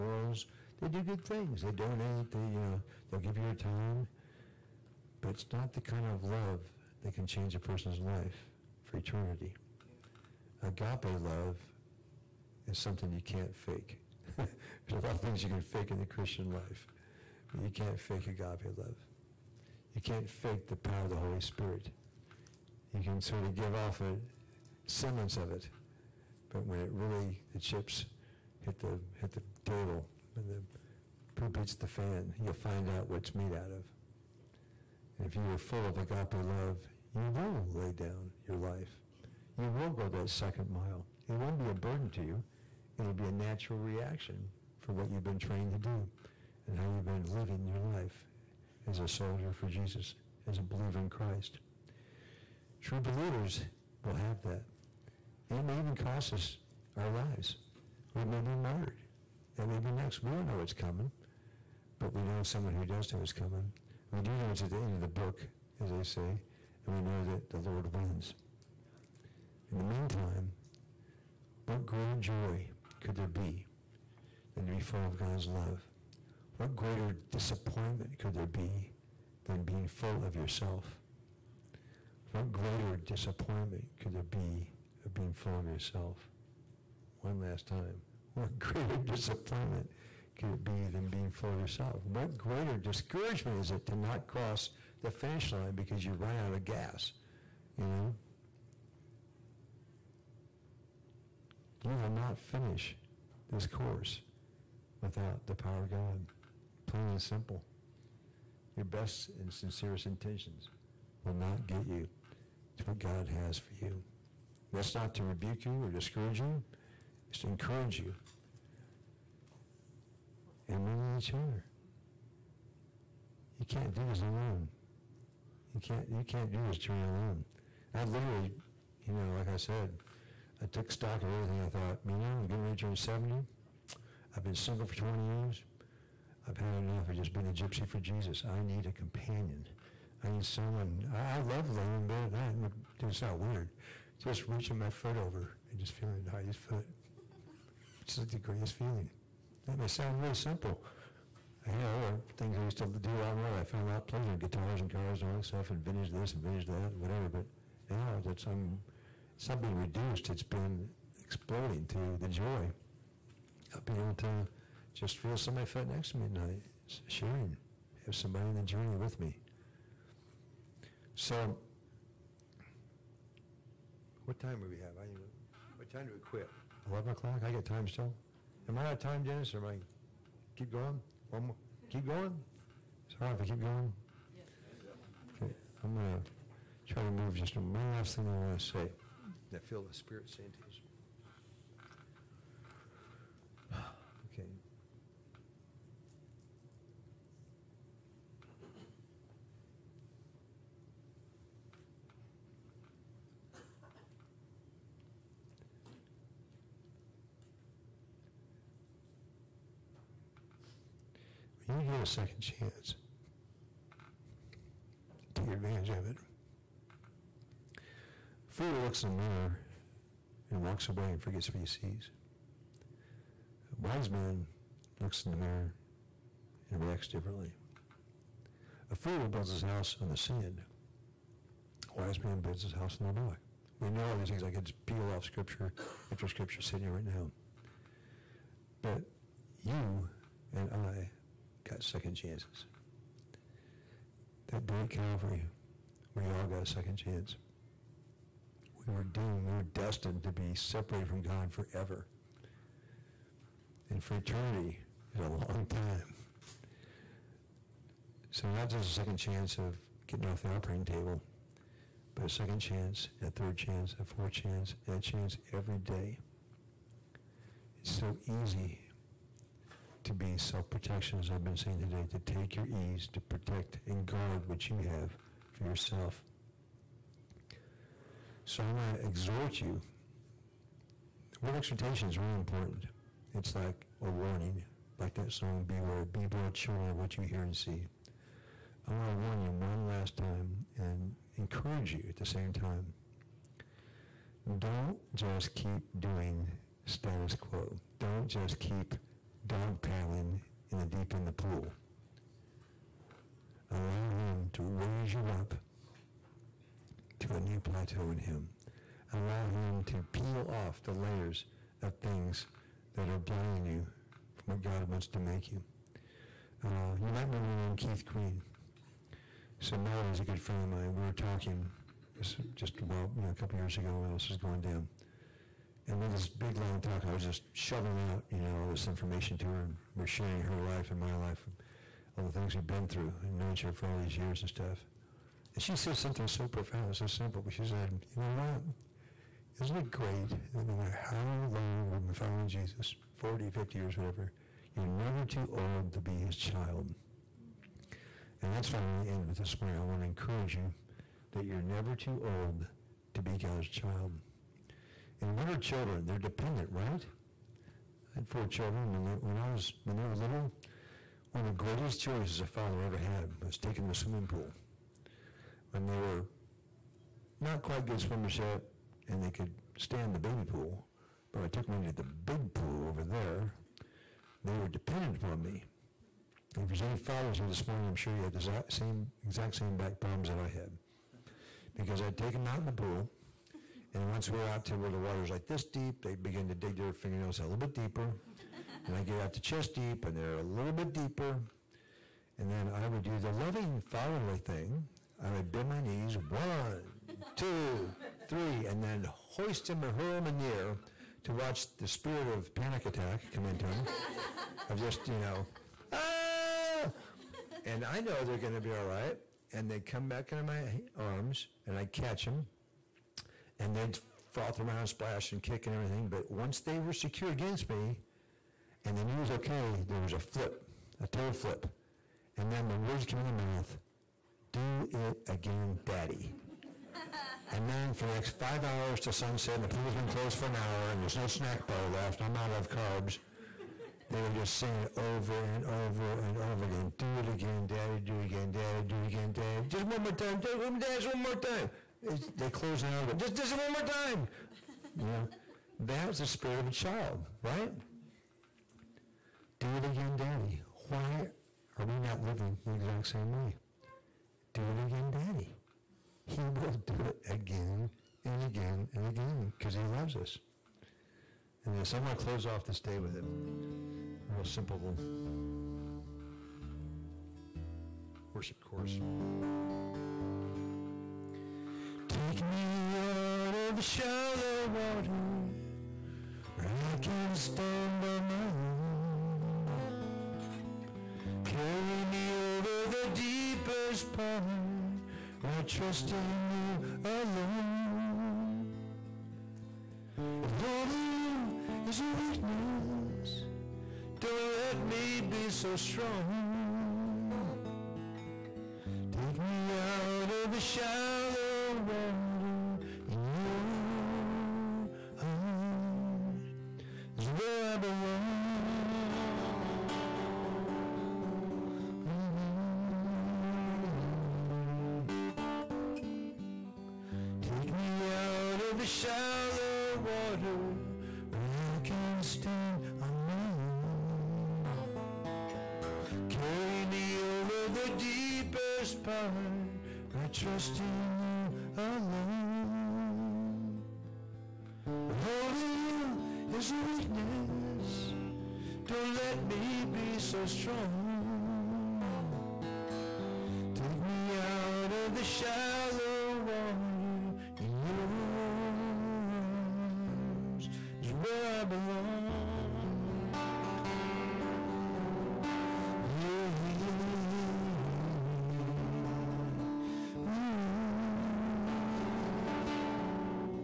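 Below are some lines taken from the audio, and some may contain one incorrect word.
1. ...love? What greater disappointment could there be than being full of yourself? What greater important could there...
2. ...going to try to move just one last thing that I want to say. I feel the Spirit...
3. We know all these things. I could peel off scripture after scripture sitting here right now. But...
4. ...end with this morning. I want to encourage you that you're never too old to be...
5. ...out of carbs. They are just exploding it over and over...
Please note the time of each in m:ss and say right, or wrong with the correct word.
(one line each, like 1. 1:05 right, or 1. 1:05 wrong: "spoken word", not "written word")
1. 1:15 wrong: "disappointment", not "important"
2. 3:05 right
3. 3:53 right
4. 5:49 right
5. 7:12 wrong: "saying", not "exploding".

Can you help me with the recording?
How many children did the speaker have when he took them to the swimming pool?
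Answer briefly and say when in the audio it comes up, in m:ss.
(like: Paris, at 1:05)
4, at 5:58.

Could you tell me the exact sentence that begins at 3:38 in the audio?
Fool looks in the mirror and walks away and forgets what he sees.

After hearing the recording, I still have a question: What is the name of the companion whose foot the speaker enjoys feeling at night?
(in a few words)
Heidi.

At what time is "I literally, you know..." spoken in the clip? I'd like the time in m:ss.
2:07.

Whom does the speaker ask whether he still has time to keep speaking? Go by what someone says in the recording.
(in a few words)
Dennis.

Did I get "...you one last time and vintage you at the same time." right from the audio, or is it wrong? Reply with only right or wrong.
wrong.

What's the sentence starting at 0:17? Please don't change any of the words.
But you can't fake agape love.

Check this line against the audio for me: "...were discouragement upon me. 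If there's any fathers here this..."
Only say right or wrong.
wrong.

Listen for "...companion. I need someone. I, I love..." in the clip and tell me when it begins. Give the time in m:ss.
2:18.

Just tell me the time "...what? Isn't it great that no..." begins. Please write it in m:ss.
5:38.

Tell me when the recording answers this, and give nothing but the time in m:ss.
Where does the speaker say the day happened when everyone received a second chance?
4:04.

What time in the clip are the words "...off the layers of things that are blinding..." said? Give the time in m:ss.
5:10.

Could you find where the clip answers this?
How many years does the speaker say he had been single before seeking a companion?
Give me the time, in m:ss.
2:14.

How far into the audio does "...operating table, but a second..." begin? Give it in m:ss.
4:20.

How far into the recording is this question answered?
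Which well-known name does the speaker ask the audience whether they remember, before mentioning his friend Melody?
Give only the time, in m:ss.
5:17.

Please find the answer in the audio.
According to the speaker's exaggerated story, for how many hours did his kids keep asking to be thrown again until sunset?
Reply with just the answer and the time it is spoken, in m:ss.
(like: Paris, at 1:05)
5, at 7:08.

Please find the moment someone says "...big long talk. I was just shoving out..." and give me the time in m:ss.
5:26.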